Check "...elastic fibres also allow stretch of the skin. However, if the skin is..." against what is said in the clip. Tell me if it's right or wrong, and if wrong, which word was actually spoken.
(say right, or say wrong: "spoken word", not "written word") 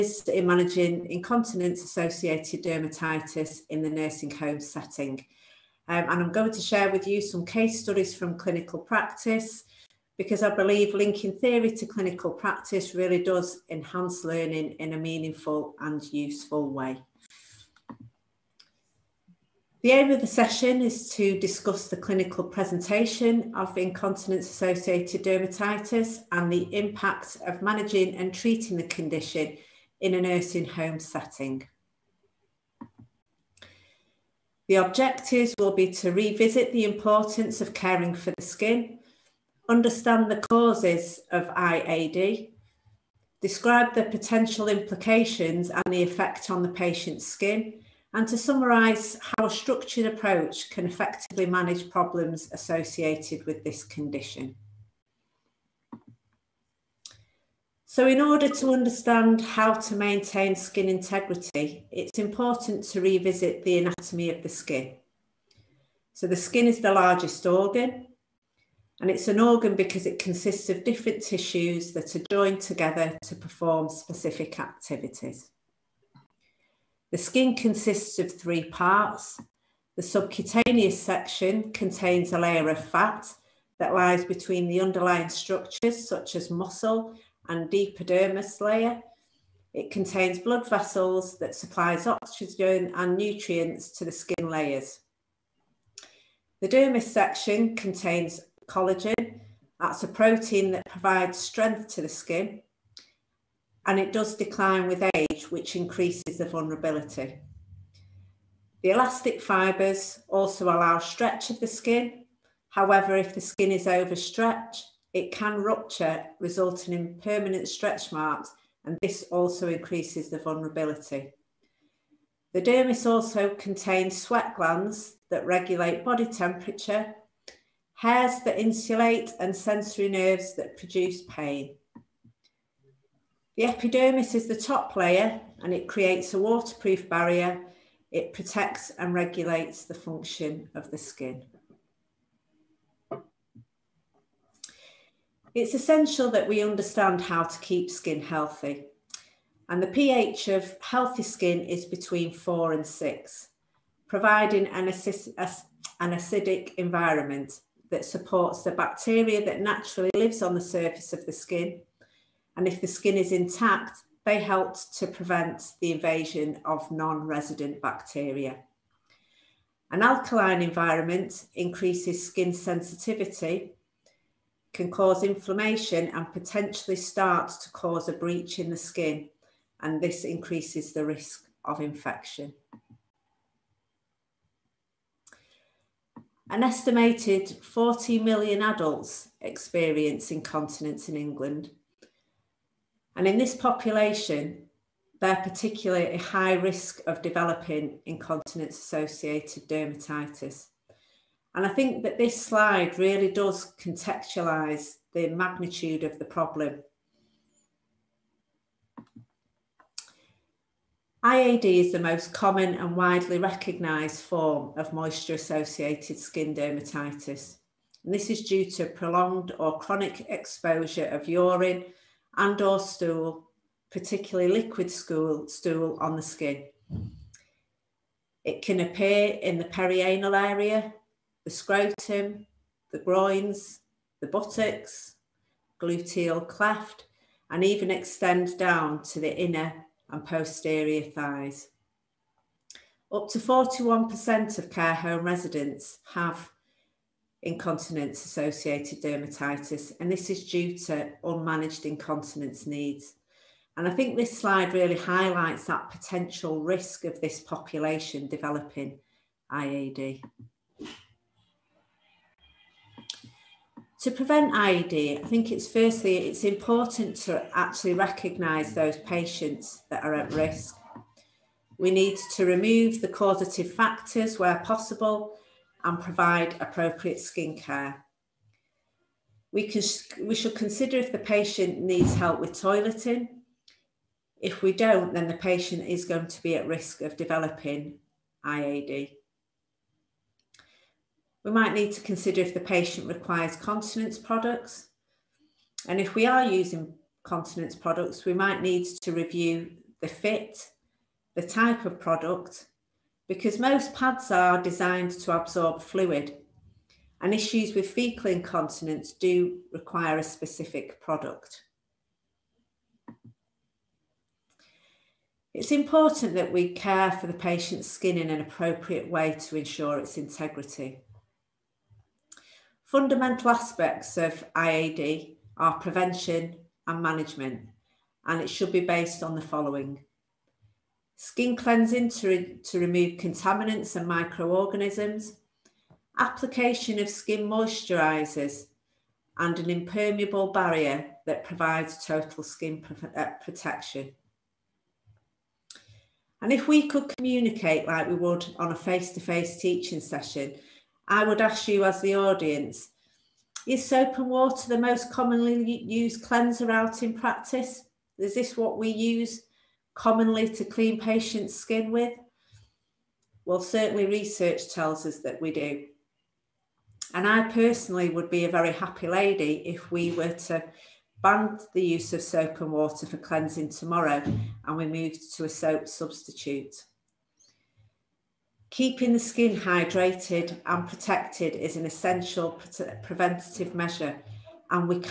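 right.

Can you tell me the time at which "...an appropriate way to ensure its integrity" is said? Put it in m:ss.
5:18.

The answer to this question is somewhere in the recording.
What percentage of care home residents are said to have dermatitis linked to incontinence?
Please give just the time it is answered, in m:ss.
4:03.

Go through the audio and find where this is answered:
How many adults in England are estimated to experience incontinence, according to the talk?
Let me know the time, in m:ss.
3:07.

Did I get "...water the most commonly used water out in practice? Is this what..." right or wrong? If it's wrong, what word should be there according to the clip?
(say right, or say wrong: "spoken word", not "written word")
wrong: "cleanser", not "water".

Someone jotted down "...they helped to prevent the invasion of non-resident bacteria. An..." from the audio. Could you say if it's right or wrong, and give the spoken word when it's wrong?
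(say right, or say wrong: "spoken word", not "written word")
right.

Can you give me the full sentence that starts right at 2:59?
And this increases the risk of infection.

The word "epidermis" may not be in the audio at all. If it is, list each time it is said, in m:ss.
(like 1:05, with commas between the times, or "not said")
1:27, 2:13.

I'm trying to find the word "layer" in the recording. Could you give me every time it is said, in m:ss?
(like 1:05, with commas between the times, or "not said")
1:22, 1:28, 1:34, 2:14.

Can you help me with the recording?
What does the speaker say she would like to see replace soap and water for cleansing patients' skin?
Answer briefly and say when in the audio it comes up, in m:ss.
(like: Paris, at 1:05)
soap substitute, at 6:15.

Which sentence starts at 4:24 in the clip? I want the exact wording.
To prevent IAD, I think it's firstly, it's important to actually recognise those patients that are at risk.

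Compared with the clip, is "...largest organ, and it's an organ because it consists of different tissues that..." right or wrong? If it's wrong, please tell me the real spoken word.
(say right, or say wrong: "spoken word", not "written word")
right.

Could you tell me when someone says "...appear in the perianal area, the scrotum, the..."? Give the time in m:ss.
3:48.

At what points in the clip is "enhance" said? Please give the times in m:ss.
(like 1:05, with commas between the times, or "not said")
0:13.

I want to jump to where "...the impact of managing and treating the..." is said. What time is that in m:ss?
0:26.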